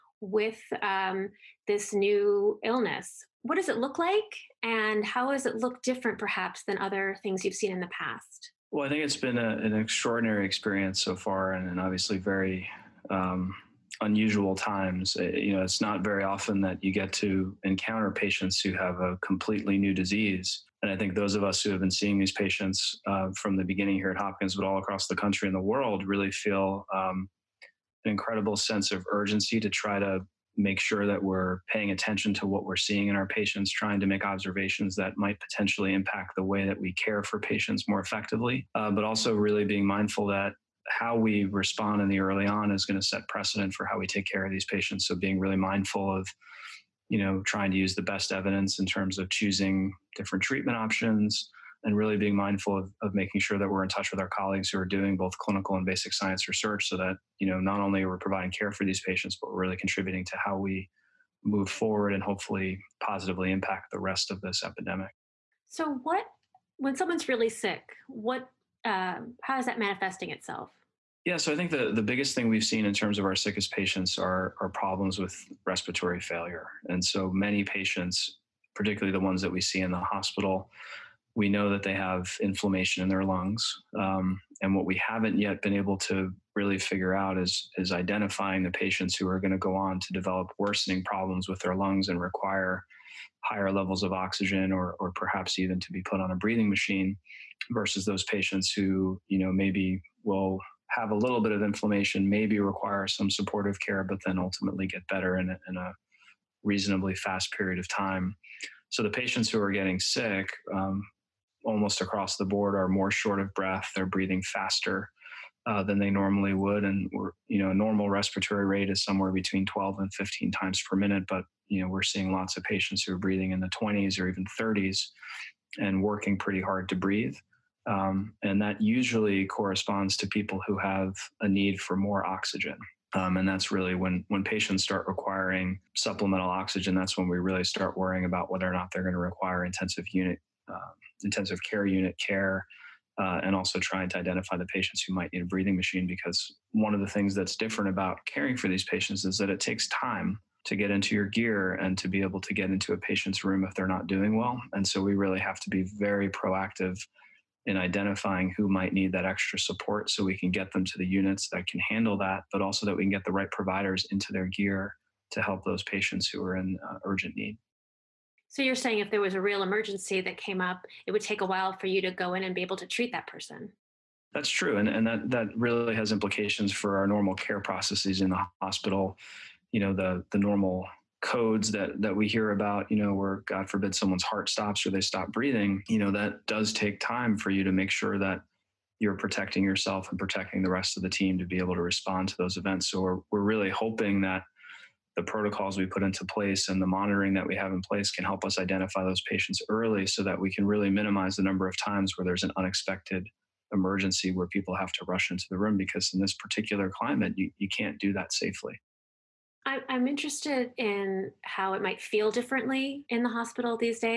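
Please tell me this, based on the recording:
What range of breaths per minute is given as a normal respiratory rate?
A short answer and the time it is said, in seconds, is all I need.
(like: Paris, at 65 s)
12 to 15, at 119 s.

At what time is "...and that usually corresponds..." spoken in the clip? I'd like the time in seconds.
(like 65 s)
128 s.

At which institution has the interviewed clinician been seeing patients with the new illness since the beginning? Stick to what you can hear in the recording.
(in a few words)
Hopkins.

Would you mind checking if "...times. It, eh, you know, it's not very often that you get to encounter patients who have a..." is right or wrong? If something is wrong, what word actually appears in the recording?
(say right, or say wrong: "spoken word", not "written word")
right.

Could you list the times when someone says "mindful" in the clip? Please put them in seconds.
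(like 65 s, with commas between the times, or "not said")
39 s, 45 s, 52 s.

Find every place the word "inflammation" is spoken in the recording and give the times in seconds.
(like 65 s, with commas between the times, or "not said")
82 s, 101 s.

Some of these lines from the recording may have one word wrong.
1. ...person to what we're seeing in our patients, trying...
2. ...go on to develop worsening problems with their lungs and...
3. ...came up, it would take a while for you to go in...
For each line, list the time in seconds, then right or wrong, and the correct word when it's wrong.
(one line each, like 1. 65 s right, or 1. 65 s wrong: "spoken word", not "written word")
1. 31 s wrong: "attention", not "person"
2. 89 s right
3. 170 s right.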